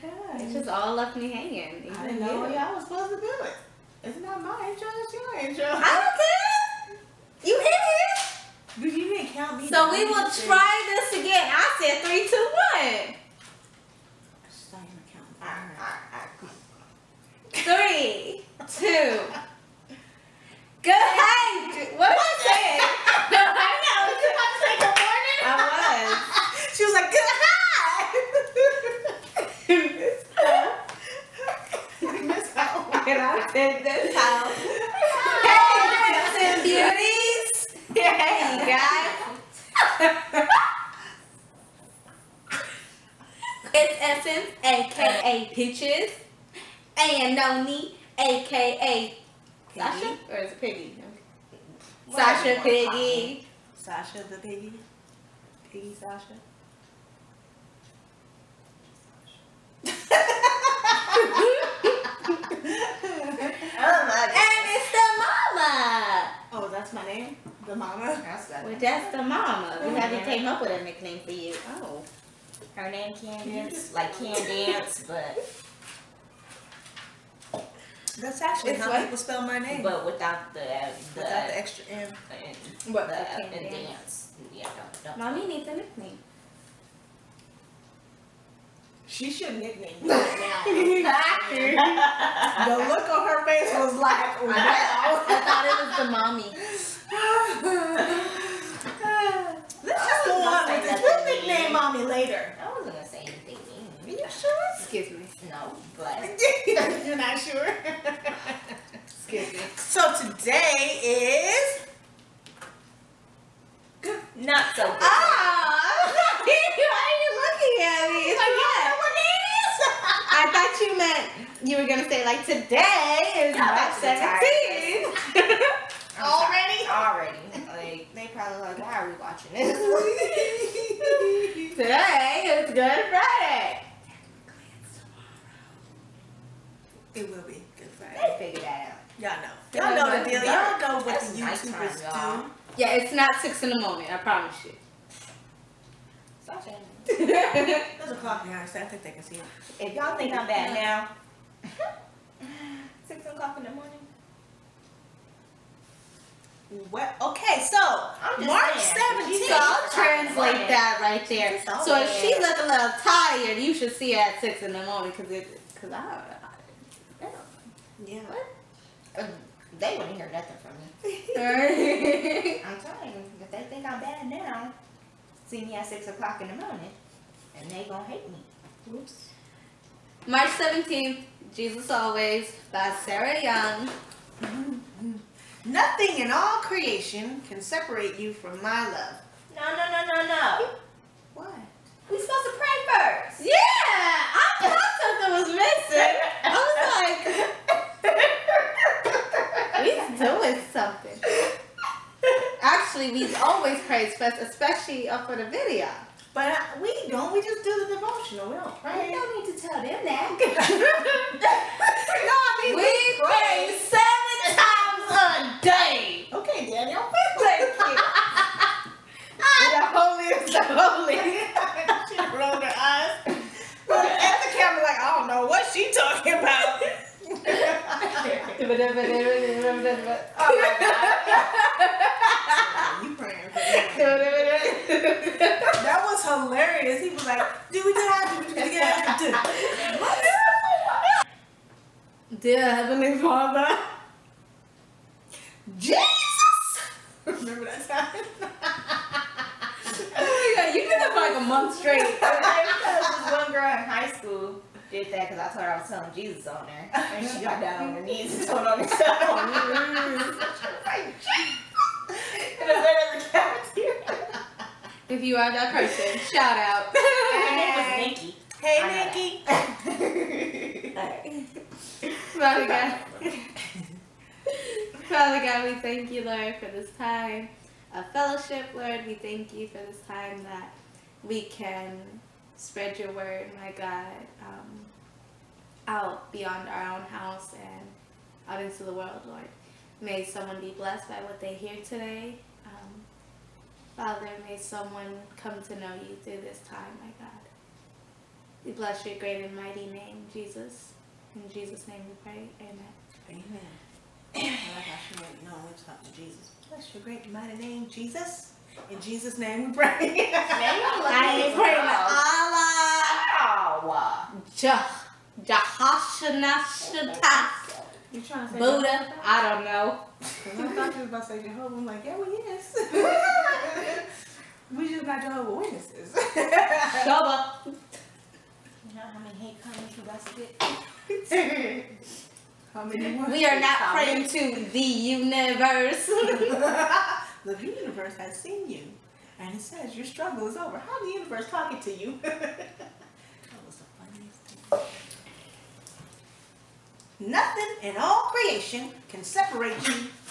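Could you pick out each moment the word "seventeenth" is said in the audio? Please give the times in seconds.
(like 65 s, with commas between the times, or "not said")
158 s, 180 s.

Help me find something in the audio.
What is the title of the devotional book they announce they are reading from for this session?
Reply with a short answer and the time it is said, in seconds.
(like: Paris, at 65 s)
Jesus Always, at 181 s.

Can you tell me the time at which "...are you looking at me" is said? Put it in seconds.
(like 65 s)
117 s.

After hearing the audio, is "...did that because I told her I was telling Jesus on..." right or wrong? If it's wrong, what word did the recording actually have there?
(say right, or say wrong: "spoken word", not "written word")
right.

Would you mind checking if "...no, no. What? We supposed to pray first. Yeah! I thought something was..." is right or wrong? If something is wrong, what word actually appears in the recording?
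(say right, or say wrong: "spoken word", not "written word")
right.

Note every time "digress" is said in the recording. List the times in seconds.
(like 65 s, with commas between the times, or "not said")
not said.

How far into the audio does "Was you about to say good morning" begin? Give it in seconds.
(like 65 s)
24 s.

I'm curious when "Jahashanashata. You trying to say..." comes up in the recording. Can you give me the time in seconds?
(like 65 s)
315 s.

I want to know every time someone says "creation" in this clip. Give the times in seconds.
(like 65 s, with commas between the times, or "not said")
186 s, 348 s.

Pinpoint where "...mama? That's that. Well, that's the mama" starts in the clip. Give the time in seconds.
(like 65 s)
67 s.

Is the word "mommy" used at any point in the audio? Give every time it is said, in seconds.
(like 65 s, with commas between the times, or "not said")
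85 s, 96 s.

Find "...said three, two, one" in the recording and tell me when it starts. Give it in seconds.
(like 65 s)
11 s.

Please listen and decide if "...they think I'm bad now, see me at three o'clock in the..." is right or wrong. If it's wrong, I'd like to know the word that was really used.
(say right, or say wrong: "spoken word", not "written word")
wrong: "six", not "three".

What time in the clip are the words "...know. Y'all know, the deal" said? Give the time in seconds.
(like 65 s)
139 s.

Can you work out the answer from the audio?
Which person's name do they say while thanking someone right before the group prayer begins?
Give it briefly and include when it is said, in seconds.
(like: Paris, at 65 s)
Daniel, at 216 s.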